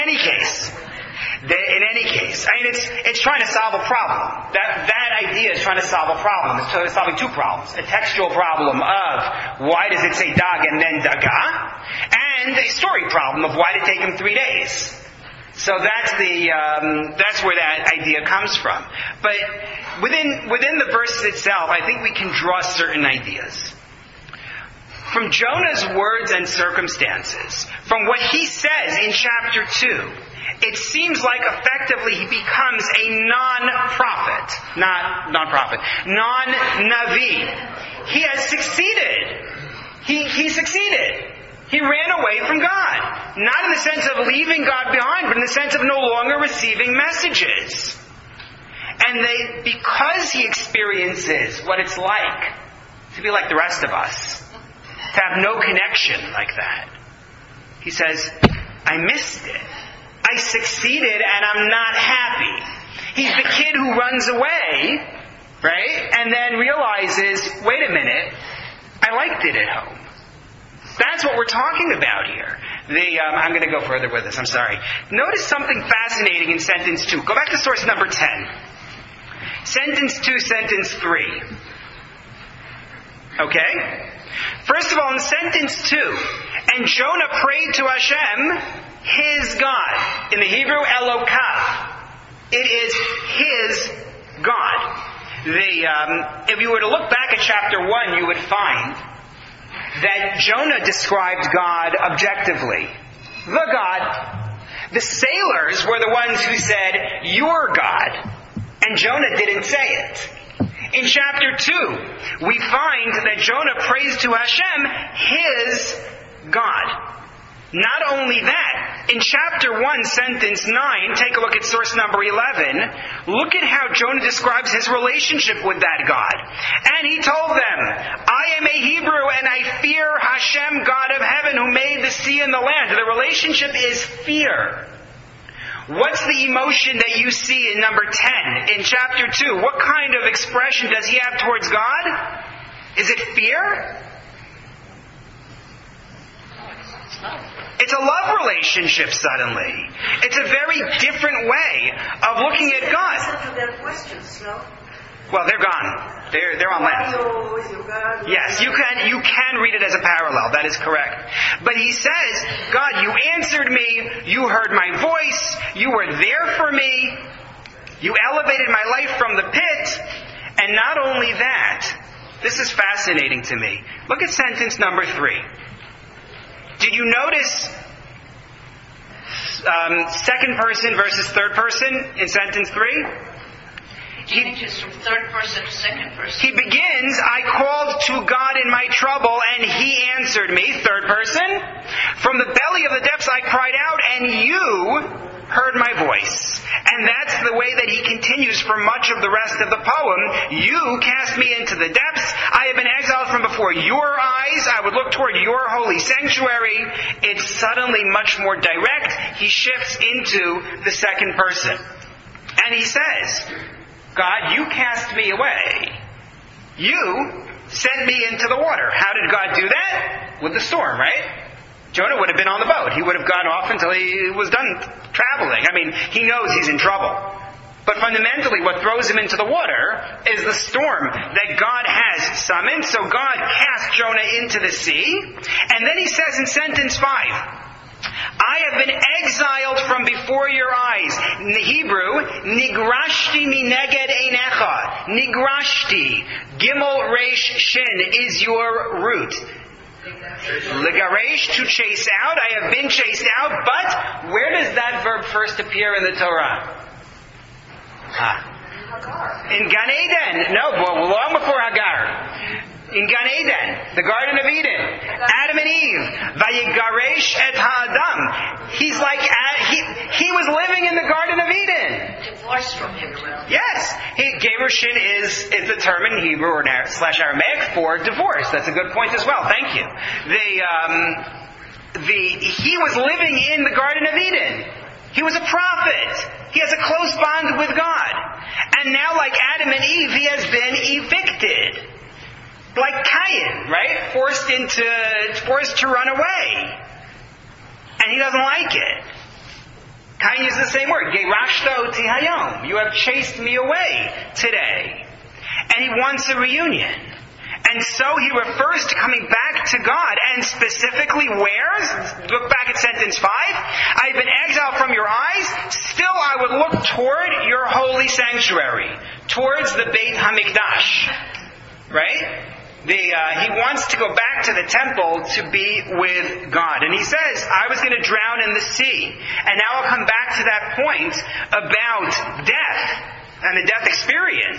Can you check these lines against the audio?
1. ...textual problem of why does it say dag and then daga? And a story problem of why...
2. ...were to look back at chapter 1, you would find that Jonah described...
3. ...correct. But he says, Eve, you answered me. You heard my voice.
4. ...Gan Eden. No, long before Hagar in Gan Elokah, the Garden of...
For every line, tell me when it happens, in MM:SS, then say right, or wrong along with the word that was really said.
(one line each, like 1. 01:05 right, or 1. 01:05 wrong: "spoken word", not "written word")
1. 00:07 right
2. 01:36 right
3. 02:40 wrong: "God", not "Eve"
4. 04:19 wrong: "Eden", not "Elokah".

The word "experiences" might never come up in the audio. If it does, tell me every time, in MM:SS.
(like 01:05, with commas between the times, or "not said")
00:50, 05:33.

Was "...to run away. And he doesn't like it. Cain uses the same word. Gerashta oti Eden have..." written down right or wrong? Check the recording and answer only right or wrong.
wrong.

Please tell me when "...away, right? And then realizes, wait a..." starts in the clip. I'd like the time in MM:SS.
01:04.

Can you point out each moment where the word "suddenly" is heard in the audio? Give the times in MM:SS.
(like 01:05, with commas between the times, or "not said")
02:29, 03:27.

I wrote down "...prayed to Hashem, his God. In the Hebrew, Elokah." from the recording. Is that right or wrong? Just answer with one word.
right.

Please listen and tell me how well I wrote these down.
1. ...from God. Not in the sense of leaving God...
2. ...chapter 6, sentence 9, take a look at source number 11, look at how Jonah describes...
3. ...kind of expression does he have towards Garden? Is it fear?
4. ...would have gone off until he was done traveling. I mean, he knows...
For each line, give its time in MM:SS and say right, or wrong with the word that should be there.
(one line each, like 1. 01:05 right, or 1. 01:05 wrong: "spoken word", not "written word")
1. 00:42 right
2. 01:59 wrong: "1", not "6"
3. 02:19 wrong: "God", not "Garden"
4. 03:43 right.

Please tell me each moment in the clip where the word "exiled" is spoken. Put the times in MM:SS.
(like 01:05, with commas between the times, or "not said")
03:22, 03:59, 05:14.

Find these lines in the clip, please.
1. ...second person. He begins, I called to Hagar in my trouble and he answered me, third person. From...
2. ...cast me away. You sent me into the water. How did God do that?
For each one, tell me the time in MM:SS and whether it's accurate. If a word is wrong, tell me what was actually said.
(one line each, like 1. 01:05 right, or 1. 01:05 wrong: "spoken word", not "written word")
1. 03:05 wrong: "God", not "Hagar"
2. 03:34 right.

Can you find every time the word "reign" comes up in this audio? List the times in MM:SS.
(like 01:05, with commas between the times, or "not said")
not said.